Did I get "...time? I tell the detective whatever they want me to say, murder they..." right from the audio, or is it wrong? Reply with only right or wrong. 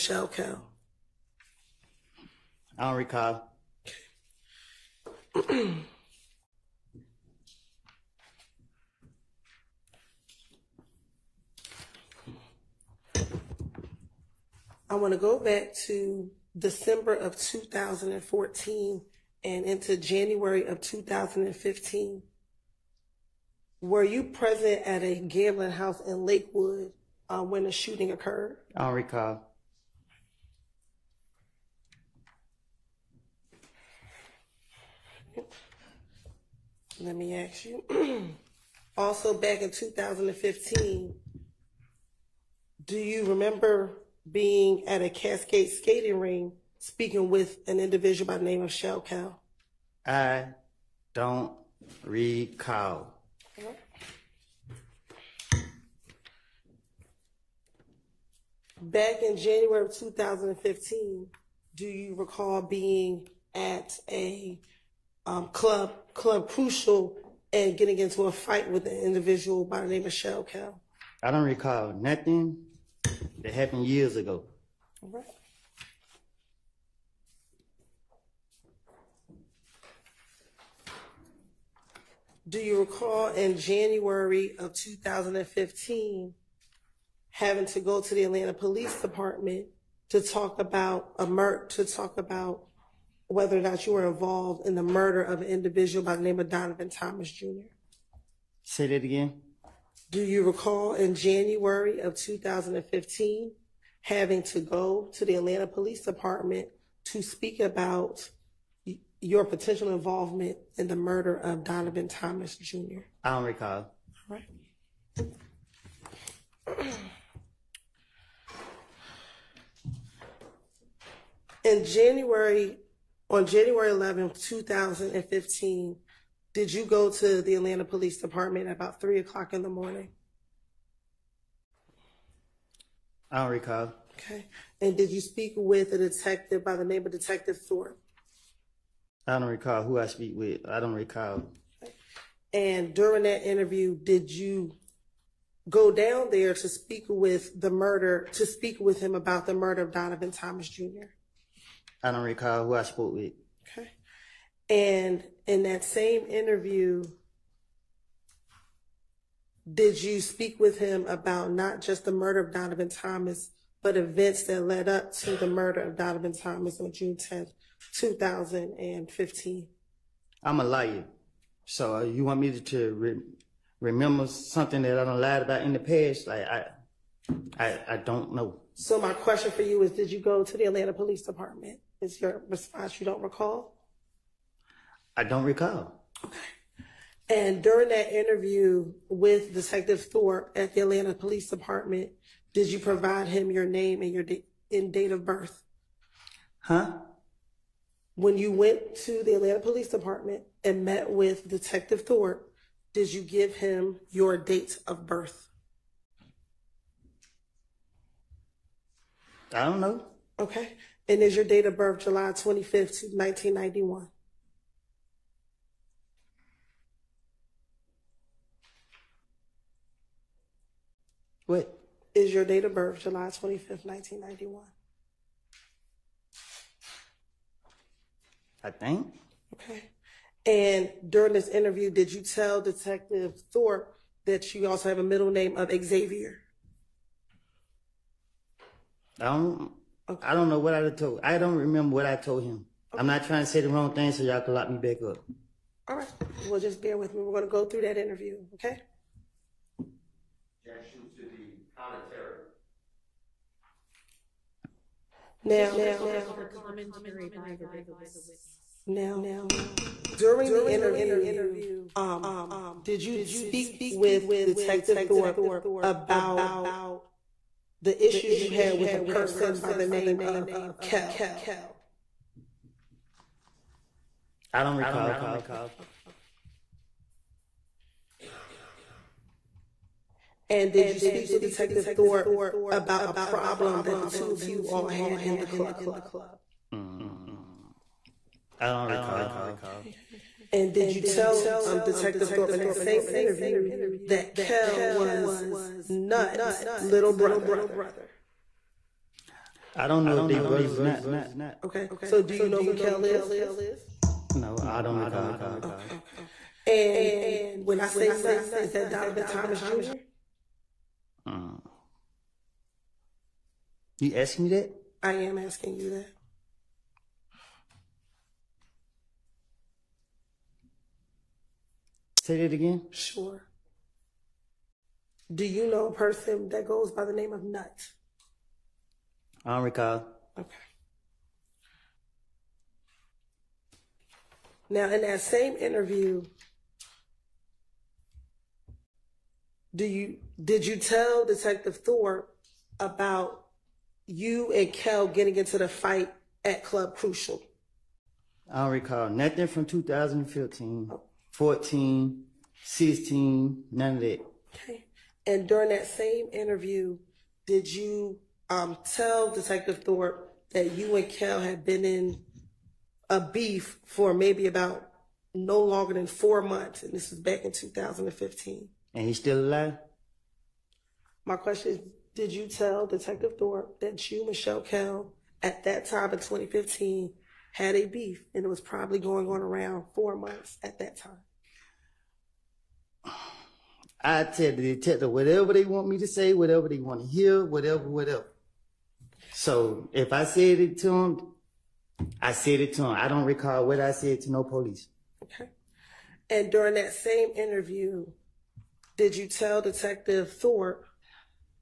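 wrong.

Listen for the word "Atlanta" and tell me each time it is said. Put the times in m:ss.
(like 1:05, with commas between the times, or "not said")
1:28, 1:45, 2:07, 3:00, 3:10, 3:19.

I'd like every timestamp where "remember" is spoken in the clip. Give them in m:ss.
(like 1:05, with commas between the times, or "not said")
0:43, 2:53, 4:01.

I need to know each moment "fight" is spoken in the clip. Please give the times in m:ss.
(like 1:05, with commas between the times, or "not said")
1:08, 5:45.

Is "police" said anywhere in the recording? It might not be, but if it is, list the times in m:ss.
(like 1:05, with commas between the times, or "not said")
1:28, 1:45, 2:07, 3:00, 3:11, 3:19, 6:34.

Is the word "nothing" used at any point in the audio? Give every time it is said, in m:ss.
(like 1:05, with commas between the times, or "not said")
1:11, 5:49.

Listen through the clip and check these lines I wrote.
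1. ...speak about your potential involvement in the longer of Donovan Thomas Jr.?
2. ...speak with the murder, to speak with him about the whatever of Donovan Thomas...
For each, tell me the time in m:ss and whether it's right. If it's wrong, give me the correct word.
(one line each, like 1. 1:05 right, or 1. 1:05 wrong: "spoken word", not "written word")
1. 1:47 wrong: "murder", not "longer"
2. 2:26 wrong: "murder", not "whatever".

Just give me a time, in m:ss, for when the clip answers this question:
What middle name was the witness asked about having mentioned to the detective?
3:55.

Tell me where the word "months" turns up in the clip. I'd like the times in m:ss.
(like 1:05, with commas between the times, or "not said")
6:06, 6:20.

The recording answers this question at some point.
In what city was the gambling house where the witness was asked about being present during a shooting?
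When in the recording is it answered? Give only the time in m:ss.
0:26.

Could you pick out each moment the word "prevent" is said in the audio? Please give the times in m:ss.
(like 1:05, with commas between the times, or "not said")
not said.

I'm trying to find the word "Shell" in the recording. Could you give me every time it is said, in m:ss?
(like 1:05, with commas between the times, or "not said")
0:48, 1:10.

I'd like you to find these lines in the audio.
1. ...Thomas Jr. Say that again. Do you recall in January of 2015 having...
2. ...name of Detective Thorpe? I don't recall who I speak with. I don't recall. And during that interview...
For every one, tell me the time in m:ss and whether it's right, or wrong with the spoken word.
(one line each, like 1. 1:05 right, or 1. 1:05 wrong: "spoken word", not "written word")
1. 1:36 right
2. 2:16 right.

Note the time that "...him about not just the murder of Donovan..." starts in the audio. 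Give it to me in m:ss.
2:40.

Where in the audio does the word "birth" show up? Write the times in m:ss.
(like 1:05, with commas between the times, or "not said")
3:15, 3:25, 3:31, 3:42.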